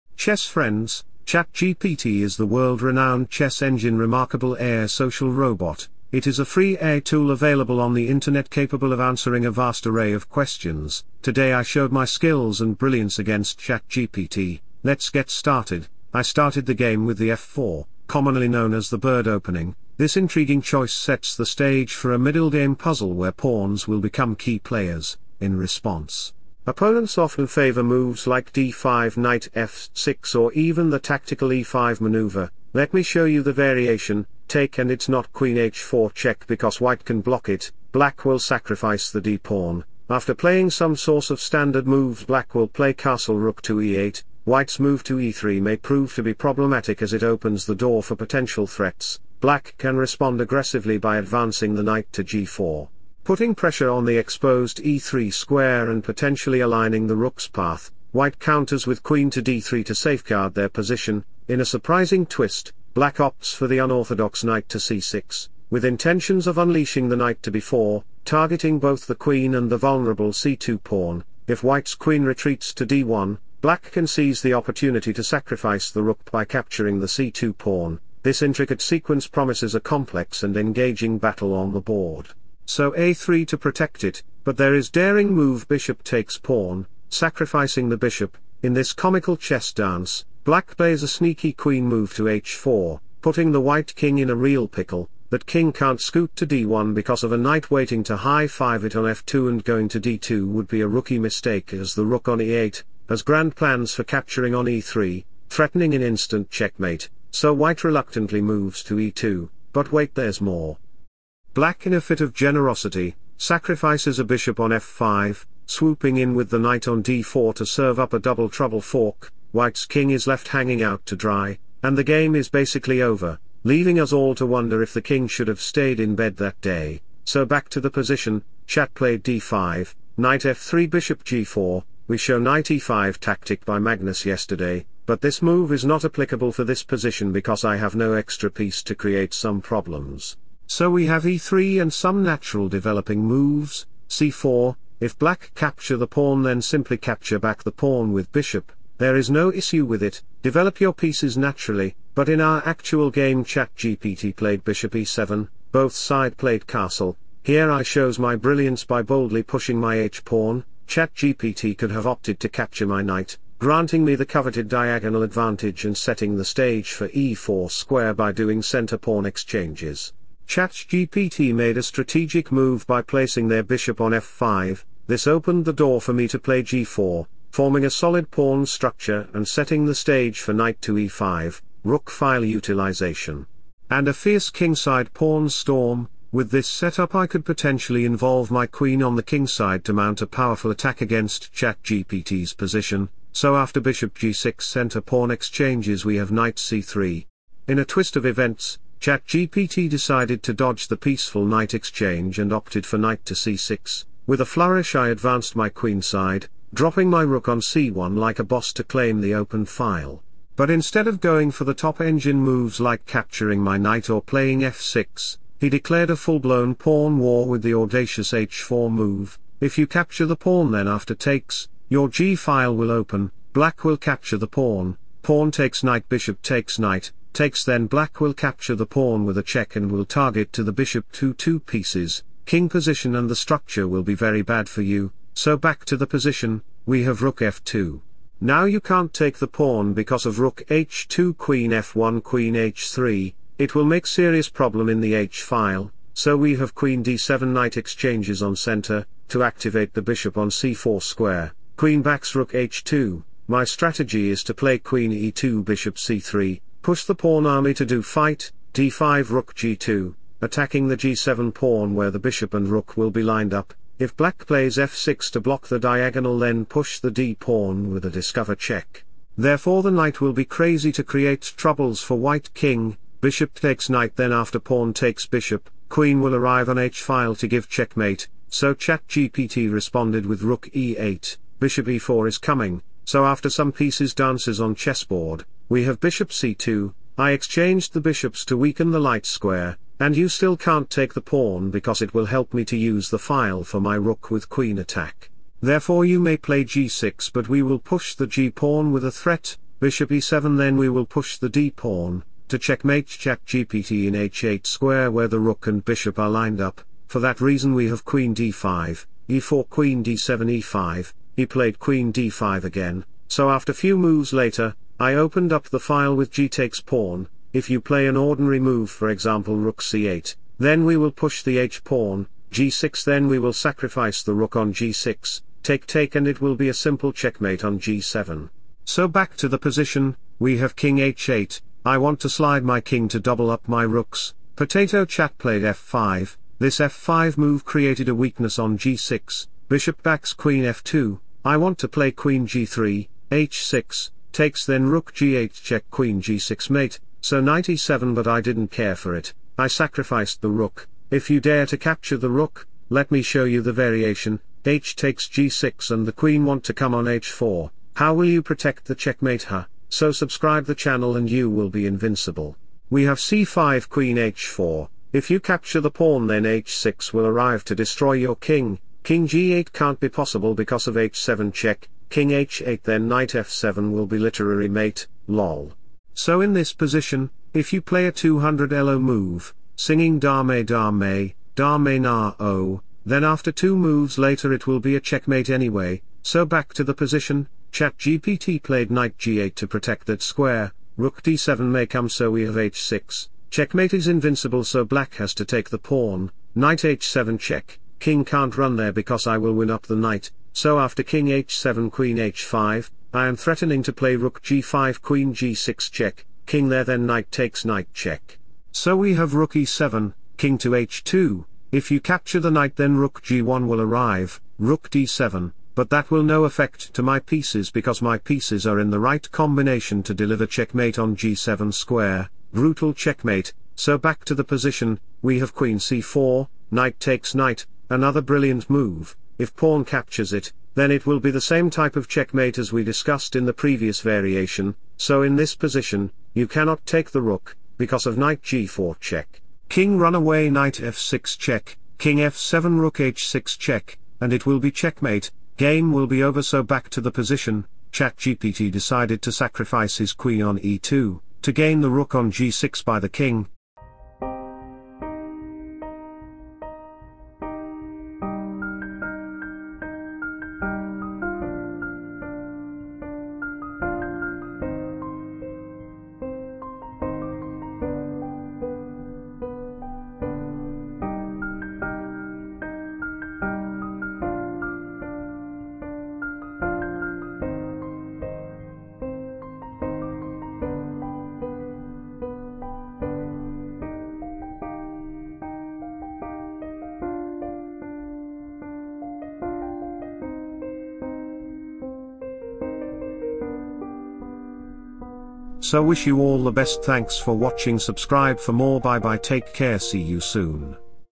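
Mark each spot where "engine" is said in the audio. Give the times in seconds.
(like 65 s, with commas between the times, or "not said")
3 s, 211 s.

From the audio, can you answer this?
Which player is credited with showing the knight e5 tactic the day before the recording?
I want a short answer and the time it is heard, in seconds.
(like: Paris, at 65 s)
Magnus, at 133 s.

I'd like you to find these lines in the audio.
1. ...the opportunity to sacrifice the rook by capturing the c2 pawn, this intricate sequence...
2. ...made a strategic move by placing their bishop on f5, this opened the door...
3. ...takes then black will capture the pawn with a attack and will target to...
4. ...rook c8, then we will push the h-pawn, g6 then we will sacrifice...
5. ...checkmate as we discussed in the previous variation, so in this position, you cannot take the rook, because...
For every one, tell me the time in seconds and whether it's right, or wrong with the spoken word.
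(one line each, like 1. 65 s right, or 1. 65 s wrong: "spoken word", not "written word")
1. 74 s right
2. 171 s right
3. 227 s wrong: "check", not "attack"
4. 319 s right
5. 432 s right.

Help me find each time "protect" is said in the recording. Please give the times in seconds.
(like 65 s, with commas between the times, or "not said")
83 s, 358 s, 389 s.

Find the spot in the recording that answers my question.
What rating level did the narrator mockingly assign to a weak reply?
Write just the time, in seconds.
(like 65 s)
378 s.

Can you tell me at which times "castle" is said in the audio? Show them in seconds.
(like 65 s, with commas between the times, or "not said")
42 s, 156 s.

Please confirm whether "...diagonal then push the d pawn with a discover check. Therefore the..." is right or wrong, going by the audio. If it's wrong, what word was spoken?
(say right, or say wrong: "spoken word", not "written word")
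right.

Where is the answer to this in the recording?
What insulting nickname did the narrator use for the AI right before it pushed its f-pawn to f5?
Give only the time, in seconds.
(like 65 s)
334 s.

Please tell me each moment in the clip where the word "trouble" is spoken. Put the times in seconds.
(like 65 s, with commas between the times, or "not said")
118 s, 271 s.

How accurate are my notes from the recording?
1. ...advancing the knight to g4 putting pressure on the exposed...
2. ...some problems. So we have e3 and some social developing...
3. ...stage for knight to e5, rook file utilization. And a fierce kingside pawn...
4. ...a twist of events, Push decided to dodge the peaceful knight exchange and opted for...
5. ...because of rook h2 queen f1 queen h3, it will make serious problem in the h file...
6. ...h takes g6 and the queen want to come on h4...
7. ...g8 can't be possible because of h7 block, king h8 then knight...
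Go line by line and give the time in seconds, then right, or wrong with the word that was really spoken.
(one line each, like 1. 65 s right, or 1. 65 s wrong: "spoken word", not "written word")
1. 51 s right
2. 139 s wrong: "natural", not "social"
3. 179 s right
4. 197 s wrong: "ChatGPT", not "Push"
5. 239 s right
6. 354 s right
7. 369 s wrong: "check", not "block".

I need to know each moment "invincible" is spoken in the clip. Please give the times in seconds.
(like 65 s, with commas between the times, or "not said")
361 s, 394 s.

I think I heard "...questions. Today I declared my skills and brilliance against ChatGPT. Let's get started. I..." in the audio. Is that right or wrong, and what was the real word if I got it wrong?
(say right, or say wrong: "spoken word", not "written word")
wrong: "showed", not "declared".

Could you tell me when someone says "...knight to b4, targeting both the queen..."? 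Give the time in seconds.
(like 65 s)
67 s.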